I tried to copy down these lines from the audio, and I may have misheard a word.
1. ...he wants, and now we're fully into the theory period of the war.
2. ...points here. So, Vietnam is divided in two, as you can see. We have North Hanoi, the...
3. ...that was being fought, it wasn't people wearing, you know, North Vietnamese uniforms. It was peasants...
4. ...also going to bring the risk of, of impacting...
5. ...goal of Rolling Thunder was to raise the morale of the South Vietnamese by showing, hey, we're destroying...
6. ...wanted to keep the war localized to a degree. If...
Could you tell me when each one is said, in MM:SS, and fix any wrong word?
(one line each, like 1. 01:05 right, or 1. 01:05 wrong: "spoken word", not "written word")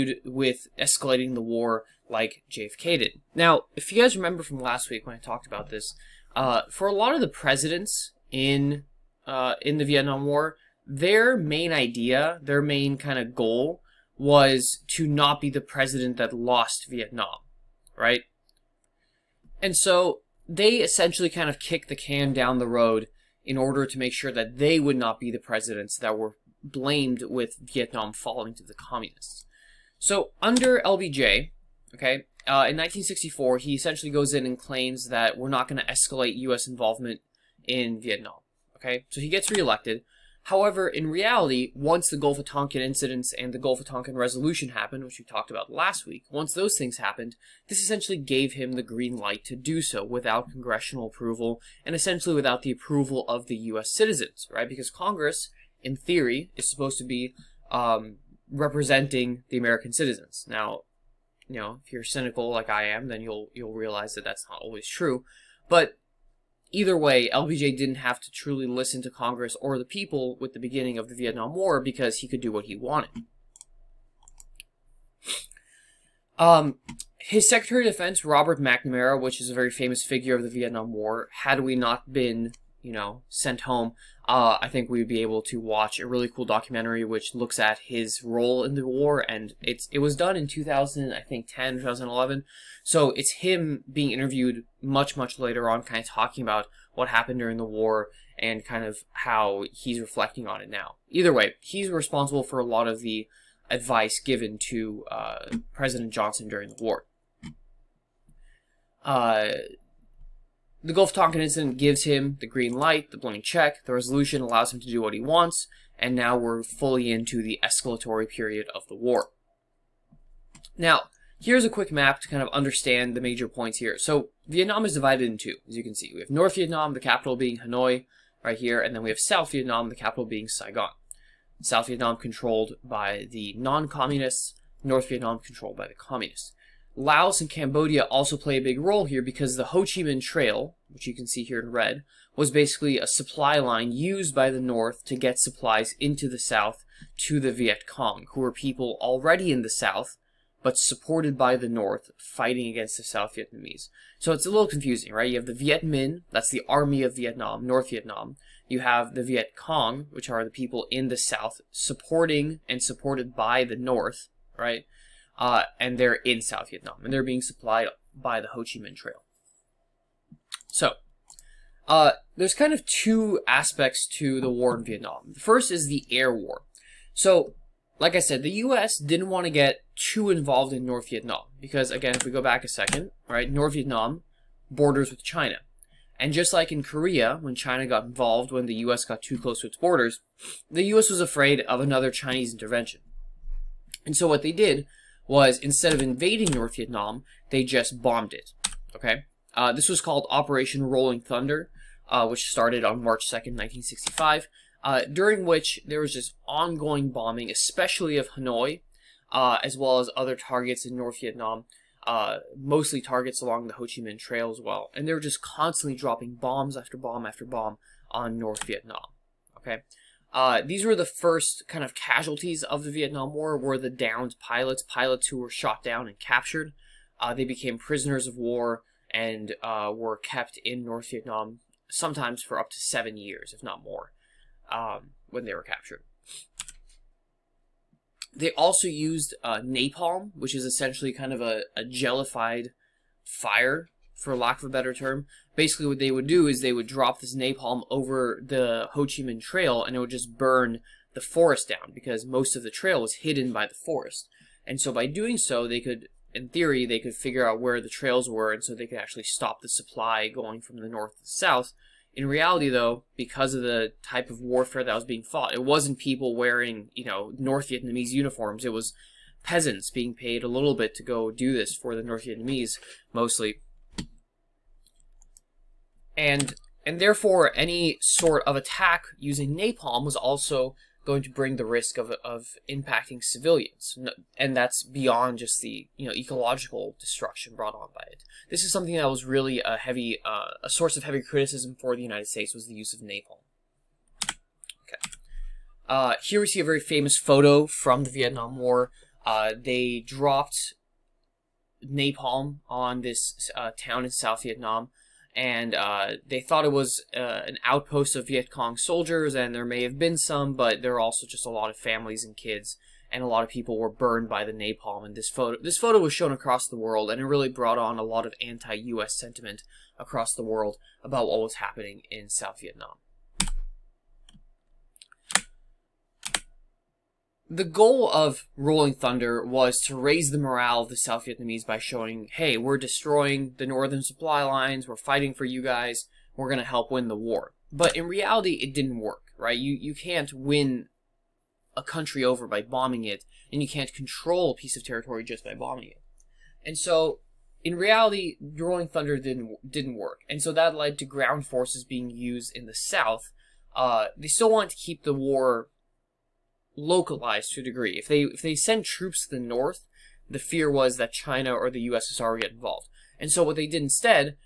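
1. 01:55 wrong: "escalatory", not "theory"
2. 02:03 wrong: "Vietnam", not "Hanoi"
3. 04:24 right
4. 04:40 right
5. 05:27 right
6. 05:54 right.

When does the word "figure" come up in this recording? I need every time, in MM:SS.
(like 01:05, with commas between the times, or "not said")
01:20, 04:17.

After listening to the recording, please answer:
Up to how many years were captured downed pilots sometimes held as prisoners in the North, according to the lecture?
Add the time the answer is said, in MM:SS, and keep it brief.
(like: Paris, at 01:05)
7, at 03:52.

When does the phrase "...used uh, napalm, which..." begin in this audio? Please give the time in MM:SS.
03:58.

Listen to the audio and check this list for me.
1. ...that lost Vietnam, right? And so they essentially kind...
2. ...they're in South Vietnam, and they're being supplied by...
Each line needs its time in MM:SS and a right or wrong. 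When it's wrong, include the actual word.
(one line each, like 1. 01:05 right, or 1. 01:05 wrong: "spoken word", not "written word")
1. 00:16 right
2. 02:45 right.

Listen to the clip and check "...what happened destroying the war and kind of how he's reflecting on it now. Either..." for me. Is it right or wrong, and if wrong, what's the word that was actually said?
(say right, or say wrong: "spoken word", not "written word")
wrong: "during", not "destroying".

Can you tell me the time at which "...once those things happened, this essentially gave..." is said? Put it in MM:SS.
00:46.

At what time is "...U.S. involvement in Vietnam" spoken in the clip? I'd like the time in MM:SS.
00:36.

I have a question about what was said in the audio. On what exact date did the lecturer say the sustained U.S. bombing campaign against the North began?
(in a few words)
March 2nd, 1965.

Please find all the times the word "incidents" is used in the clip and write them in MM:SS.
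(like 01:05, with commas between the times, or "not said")
00:42, 01:51.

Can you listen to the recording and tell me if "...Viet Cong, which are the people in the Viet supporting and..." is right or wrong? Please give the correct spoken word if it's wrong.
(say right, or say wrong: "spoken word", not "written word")
wrong: "South", not "Viet".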